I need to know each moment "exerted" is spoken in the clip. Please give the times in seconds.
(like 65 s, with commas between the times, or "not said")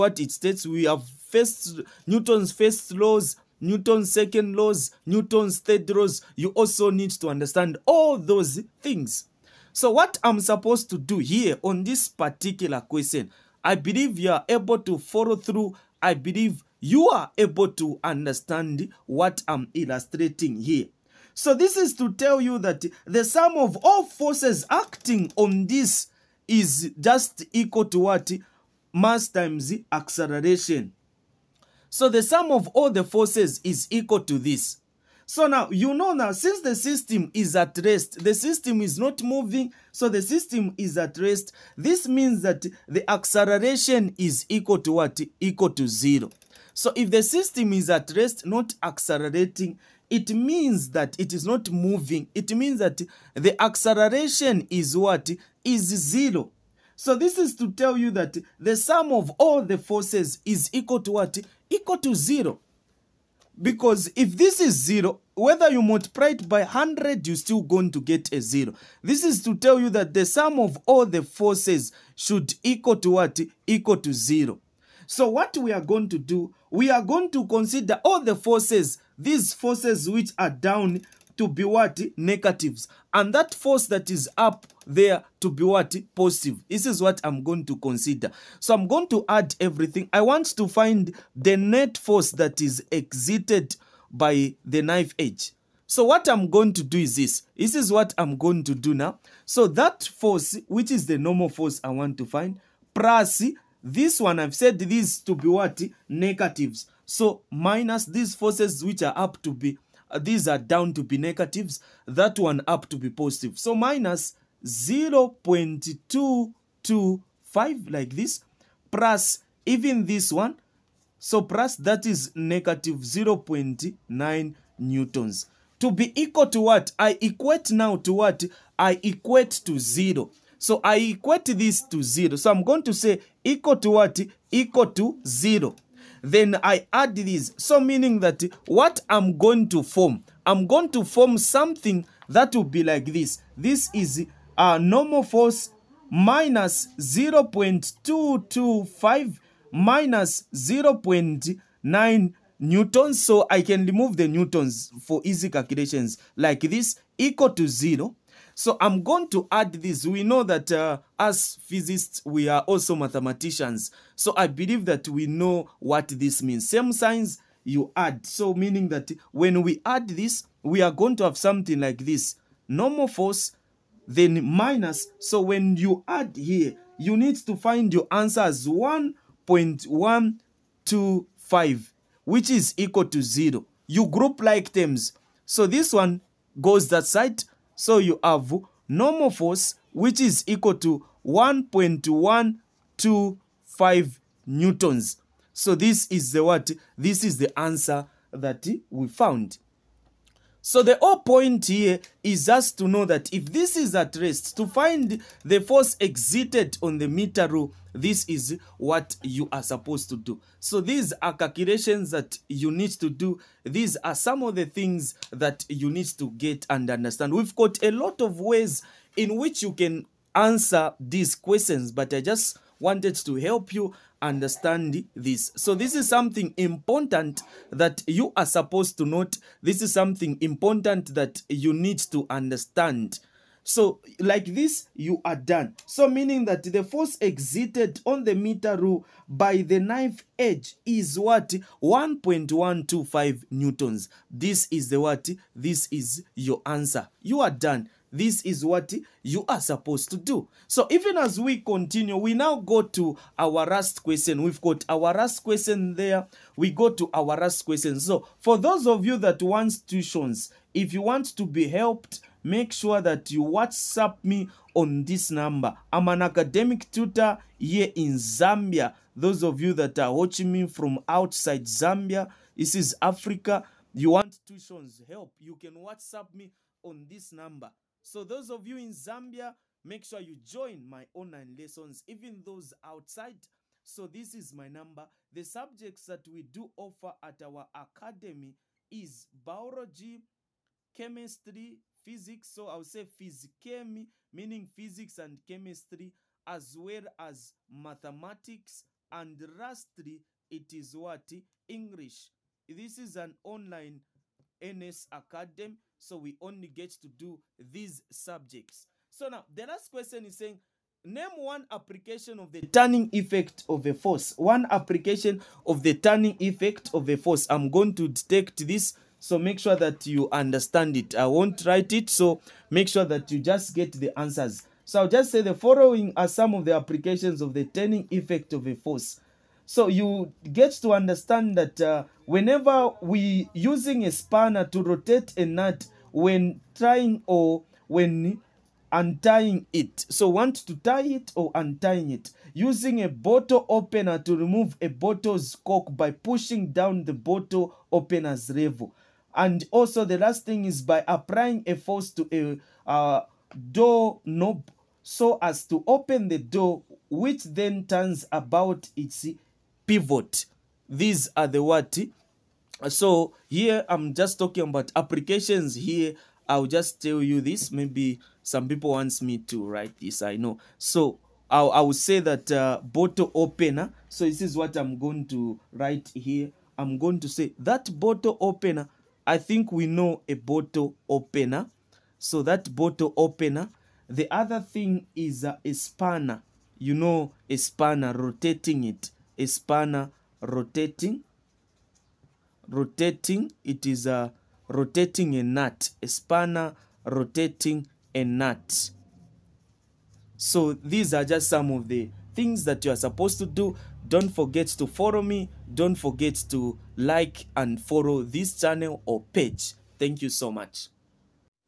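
206 s.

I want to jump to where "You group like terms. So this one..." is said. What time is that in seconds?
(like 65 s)
183 s.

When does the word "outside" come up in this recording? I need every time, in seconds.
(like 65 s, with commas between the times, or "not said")
271 s, 282 s.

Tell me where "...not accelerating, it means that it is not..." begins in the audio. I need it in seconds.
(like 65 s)
48 s.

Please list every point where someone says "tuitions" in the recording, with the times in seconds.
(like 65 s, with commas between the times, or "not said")
259 s, 274 s.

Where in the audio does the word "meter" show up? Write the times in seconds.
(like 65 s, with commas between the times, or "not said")
207 s, 238 s.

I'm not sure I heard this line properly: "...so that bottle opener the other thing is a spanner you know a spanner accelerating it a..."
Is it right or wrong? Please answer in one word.
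wrong.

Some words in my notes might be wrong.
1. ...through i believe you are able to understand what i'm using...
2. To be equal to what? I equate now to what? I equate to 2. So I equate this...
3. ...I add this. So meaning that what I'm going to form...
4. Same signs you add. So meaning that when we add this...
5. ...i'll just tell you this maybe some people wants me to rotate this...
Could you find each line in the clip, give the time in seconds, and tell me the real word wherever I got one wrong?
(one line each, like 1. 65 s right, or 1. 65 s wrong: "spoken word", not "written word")
1. 15 s wrong: "illustrating", not "using"
2. 125 s wrong: "0", not "2"
3. 136 s right
4. 166 s right
5. 366 s wrong: "write", not "rotate".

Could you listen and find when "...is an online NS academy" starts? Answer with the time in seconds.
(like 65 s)
302 s.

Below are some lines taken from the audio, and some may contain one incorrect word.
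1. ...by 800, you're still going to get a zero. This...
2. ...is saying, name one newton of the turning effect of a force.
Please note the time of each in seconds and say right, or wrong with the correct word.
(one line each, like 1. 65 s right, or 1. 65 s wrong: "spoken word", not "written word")
1. 66 s wrong: "100", not "800"
2. 310 s wrong: "application", not "newton".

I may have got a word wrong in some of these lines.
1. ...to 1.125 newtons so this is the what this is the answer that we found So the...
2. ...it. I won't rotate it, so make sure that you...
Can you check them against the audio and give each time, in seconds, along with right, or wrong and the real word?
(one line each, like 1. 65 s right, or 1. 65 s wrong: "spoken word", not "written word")
1. 190 s right
2. 320 s wrong: "write", not "rotate".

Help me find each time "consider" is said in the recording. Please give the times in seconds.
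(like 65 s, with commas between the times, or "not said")
77 s, 87 s.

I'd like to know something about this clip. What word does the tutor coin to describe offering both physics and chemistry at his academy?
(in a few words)
physikemi.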